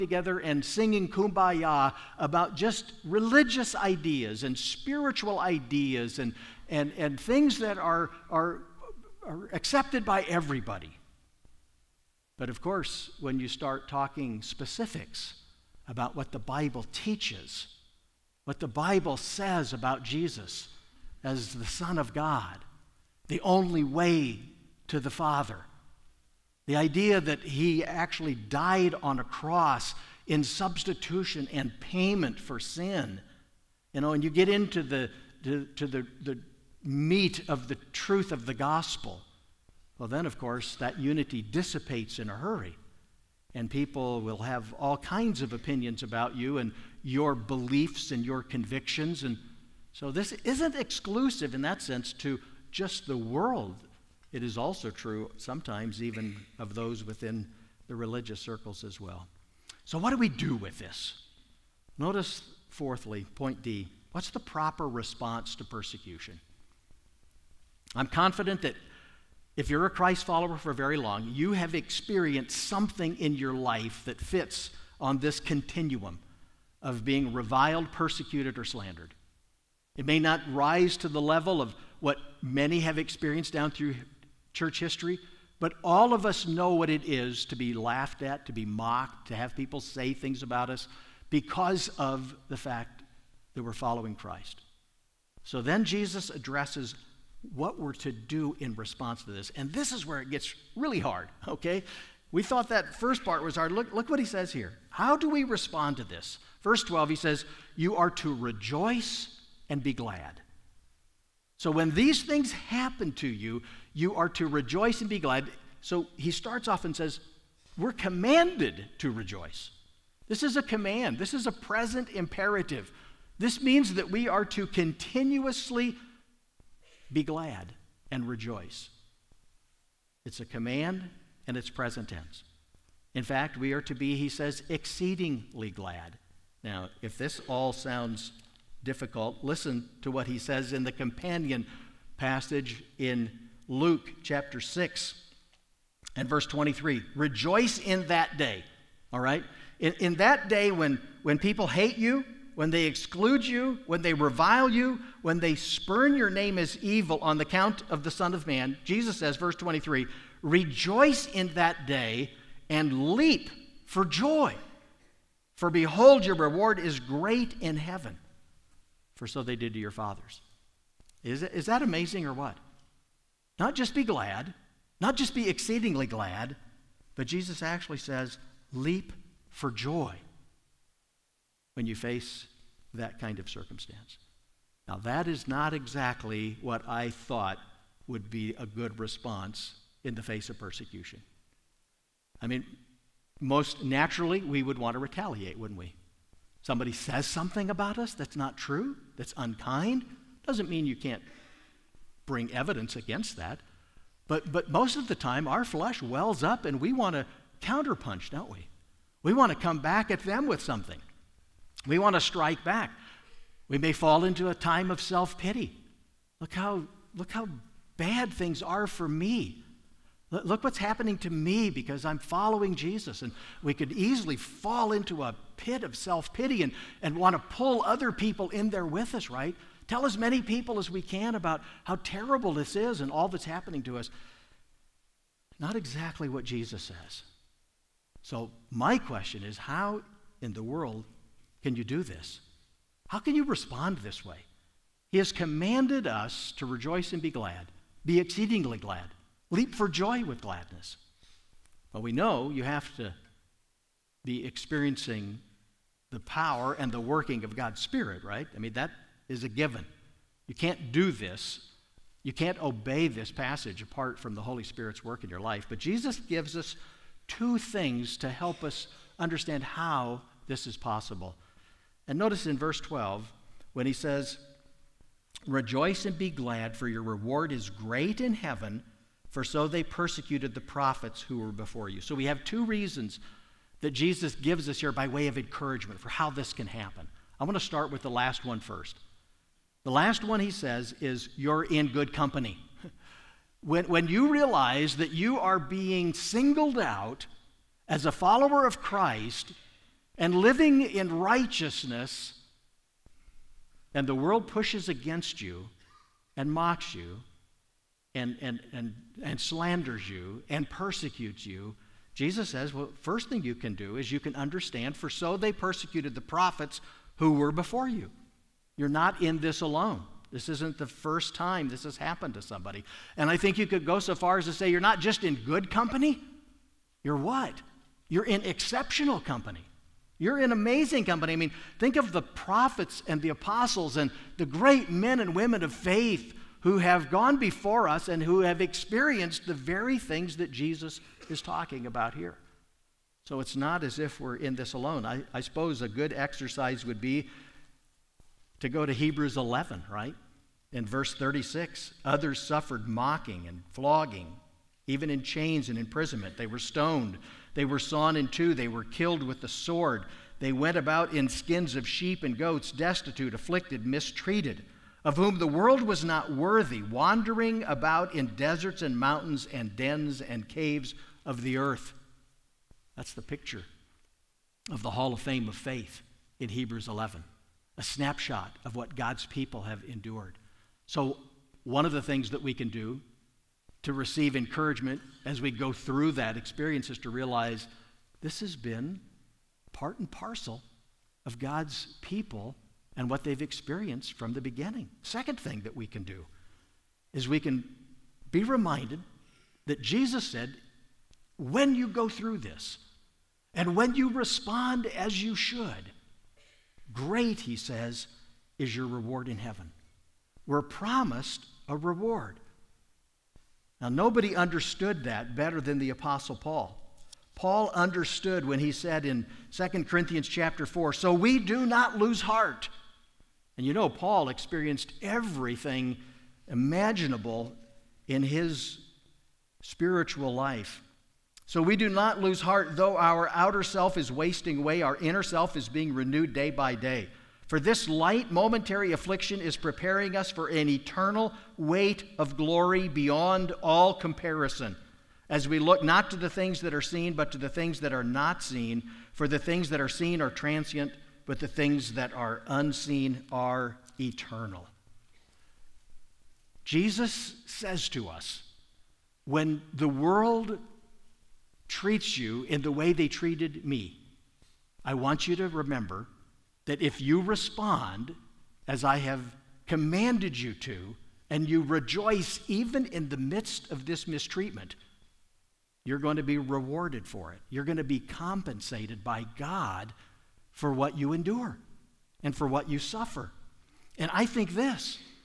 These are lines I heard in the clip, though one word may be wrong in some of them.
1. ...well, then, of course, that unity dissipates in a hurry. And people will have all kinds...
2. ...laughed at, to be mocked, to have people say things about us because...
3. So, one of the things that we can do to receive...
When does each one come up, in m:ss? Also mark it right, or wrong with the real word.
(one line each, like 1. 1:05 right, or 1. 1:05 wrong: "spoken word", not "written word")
1. 0:39 right
2. 1:27 right
3. 6:20 right.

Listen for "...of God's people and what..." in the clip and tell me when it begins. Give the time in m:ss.
6:31.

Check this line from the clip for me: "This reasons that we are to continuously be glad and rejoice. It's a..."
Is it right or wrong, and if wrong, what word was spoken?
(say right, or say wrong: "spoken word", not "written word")
wrong: "means", not "reasons".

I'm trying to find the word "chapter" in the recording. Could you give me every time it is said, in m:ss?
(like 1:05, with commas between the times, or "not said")
2:24, 7:00.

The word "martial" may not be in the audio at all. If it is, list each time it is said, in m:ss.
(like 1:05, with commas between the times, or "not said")
not said.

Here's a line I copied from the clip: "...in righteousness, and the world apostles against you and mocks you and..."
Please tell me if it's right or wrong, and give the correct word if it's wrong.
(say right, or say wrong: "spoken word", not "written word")
wrong: "pushes", not "apostles".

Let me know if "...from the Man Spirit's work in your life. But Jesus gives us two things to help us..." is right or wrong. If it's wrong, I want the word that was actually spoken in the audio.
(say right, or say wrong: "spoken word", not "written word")
wrong: "Holy", not "Man".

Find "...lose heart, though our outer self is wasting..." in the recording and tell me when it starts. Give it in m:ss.
7:12.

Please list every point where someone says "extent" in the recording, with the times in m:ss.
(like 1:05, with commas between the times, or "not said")
not said.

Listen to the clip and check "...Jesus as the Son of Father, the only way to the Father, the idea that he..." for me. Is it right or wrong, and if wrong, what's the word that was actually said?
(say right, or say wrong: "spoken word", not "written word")
wrong: "God", not "Father".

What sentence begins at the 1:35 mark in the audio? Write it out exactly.
So then Jesus addresses what we're to do in response to this.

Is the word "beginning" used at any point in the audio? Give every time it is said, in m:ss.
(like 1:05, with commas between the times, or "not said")
6:34.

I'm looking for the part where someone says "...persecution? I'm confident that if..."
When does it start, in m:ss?
1:05.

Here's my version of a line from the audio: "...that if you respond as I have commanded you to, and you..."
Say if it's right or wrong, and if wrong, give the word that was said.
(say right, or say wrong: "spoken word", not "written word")
right.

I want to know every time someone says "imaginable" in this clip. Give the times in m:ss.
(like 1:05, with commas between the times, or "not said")
7:06.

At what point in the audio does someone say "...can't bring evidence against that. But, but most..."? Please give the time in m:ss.
3:20.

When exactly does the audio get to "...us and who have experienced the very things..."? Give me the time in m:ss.
5:37.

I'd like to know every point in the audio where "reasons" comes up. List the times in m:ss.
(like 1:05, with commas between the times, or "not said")
4:42.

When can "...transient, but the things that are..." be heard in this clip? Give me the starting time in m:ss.
7:30.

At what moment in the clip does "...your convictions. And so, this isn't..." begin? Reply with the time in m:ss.
0:48.